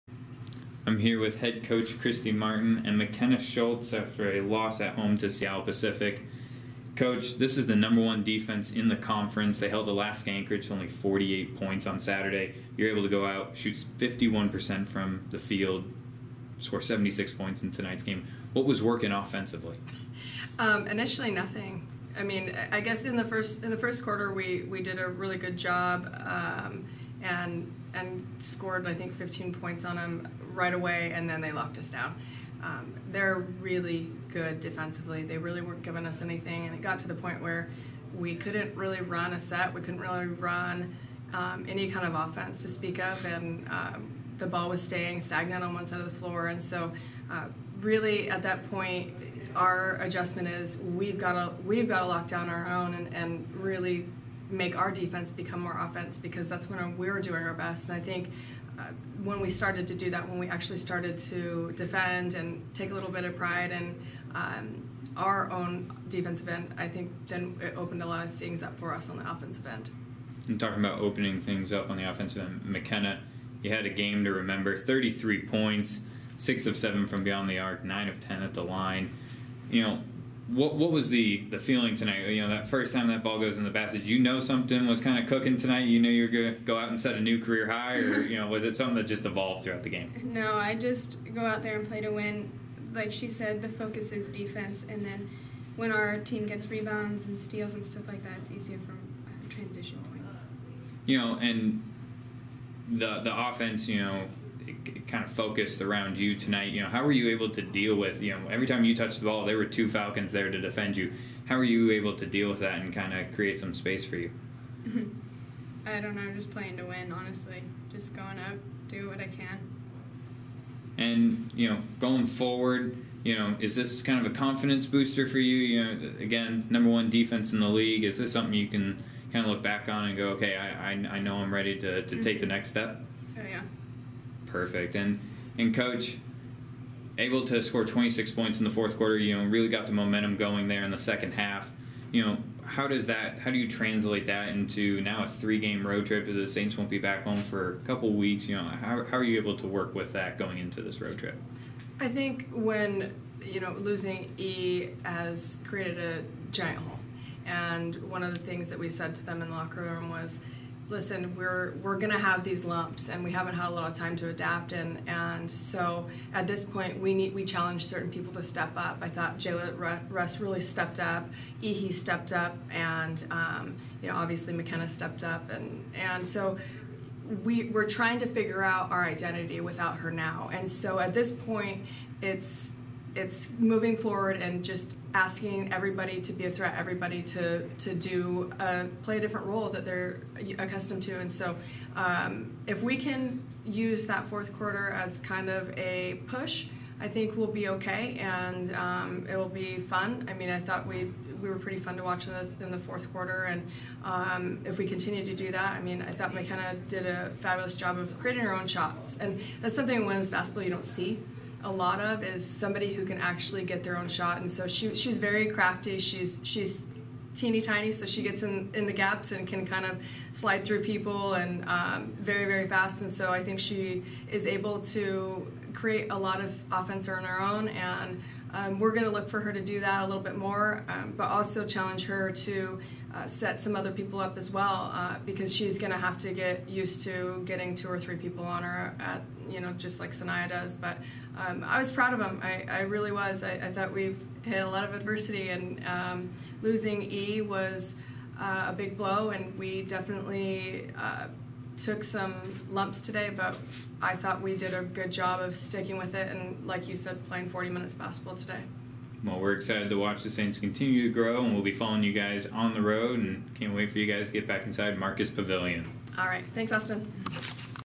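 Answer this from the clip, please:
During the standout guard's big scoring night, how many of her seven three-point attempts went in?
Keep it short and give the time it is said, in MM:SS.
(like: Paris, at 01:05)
6, at 01:16.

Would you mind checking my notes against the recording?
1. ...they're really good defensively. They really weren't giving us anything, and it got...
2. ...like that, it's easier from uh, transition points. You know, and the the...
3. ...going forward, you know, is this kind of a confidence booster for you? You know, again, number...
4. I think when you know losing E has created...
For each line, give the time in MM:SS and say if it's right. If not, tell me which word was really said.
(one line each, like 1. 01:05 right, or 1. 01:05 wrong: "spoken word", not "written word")
1. 00:33 right
2. 01:38 right
3. 02:01 right
4. 02:31 right.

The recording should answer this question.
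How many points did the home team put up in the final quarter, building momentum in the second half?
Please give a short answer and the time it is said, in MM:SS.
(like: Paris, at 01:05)
26, at 02:17.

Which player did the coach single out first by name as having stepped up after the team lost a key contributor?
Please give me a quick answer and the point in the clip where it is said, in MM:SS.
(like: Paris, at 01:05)
Jayla Russ, at 02:49.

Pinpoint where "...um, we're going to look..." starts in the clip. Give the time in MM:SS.
03:48.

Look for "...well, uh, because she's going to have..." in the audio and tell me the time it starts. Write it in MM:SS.
03:54.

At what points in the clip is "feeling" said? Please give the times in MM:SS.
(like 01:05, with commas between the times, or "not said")
01:21.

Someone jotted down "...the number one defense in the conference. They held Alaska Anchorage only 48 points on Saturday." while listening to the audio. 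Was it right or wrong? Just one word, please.
right.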